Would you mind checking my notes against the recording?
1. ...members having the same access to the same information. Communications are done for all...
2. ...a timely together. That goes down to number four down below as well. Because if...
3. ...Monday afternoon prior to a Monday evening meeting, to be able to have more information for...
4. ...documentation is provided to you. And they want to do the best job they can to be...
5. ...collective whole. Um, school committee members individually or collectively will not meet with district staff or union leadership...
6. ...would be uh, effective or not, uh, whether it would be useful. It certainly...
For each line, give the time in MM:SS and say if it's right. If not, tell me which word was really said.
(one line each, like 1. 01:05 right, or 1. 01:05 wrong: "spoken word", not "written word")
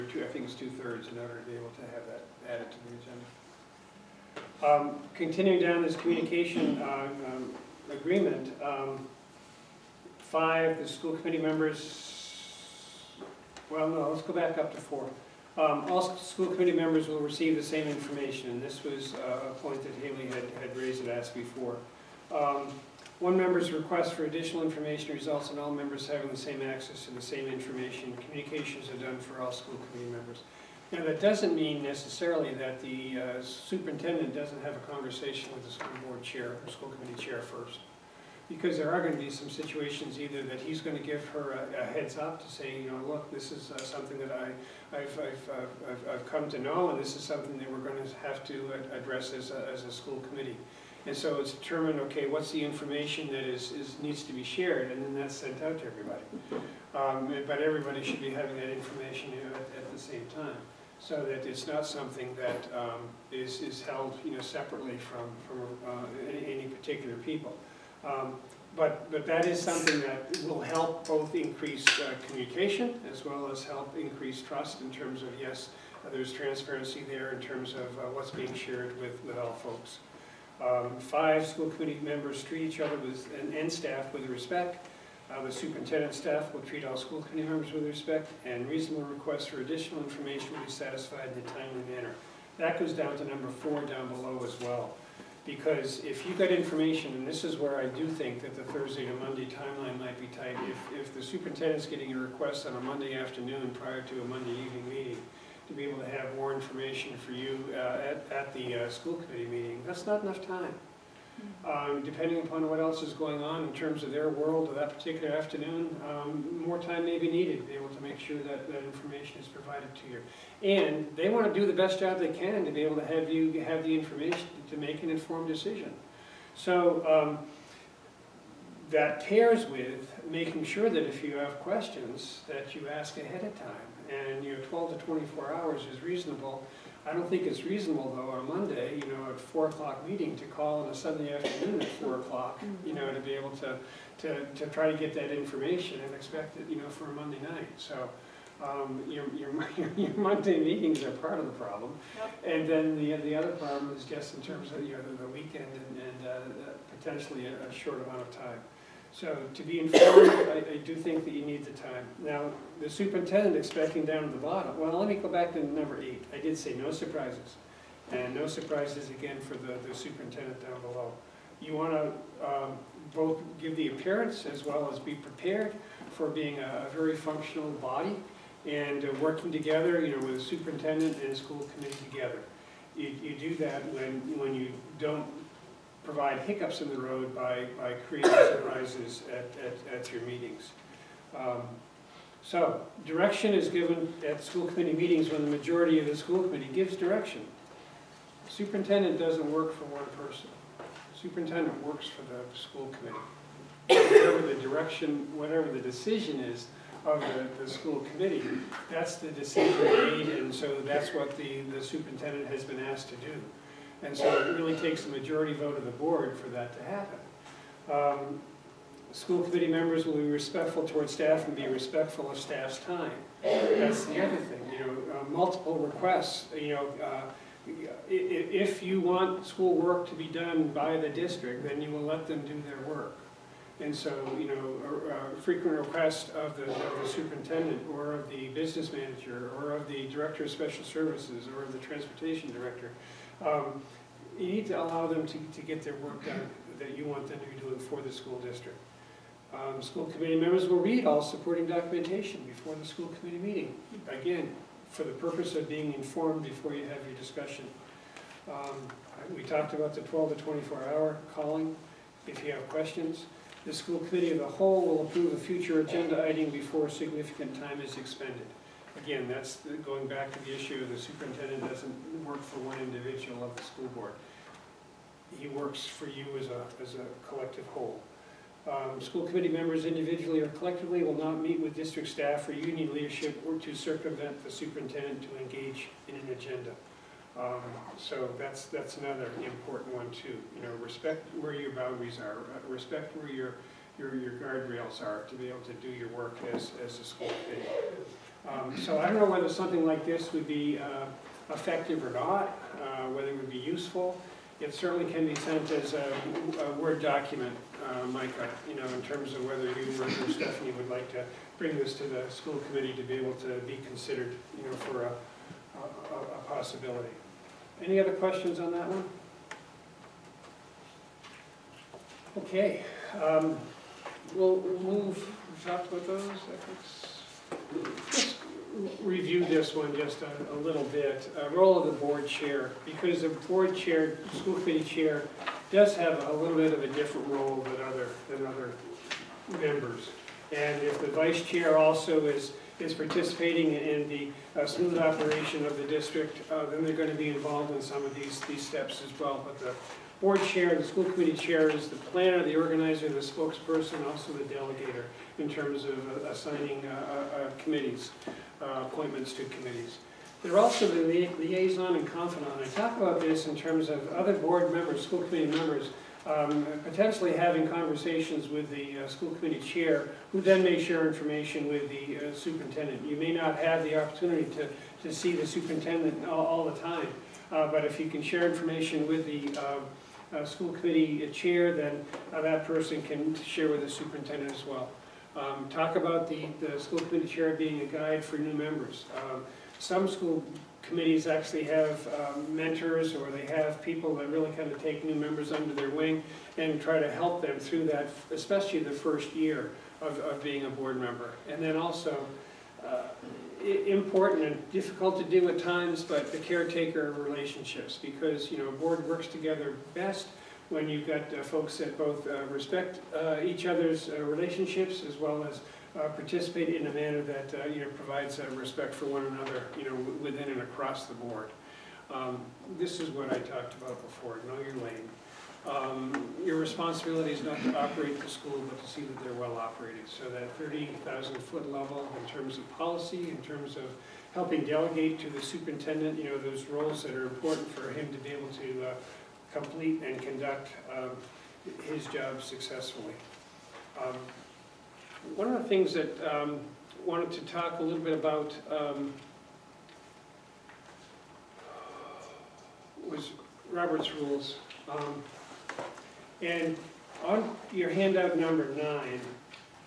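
1. 00:25 right
2. 01:31 wrong: "manner", not "together"
3. 01:42 right
4. 01:58 wrong: "information", not "documentation"
5. 04:37 right
6. 05:00 right.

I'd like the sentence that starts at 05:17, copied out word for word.
Any other questions on that one?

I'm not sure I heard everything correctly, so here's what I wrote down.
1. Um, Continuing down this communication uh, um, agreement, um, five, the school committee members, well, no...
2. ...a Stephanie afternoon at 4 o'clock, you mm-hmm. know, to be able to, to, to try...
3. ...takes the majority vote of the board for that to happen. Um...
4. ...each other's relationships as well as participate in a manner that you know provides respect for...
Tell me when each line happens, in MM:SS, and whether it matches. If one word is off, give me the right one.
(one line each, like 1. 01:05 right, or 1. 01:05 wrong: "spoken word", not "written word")
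1. 00:04 right
2. 02:20 wrong: "Sunday", not "Stephanie"
3. 03:34 right
4. 06:53 right.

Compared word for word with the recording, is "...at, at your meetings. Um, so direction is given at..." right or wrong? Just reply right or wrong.
right.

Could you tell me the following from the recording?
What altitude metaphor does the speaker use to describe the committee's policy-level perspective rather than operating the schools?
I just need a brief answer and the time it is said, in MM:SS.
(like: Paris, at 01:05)
30,000 foot, at 07:10.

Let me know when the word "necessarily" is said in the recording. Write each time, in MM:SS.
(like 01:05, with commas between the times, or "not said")
00:31.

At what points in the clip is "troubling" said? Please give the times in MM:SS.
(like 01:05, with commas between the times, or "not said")
not said.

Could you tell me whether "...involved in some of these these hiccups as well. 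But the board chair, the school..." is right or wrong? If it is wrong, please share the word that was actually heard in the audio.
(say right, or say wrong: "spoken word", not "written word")
wrong: "steps", not "hiccups".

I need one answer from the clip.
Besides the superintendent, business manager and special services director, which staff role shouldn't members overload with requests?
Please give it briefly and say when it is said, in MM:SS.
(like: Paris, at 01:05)
transportation director, at 04:01.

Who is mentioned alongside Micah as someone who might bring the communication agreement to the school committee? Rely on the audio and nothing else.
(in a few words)
Stephanie.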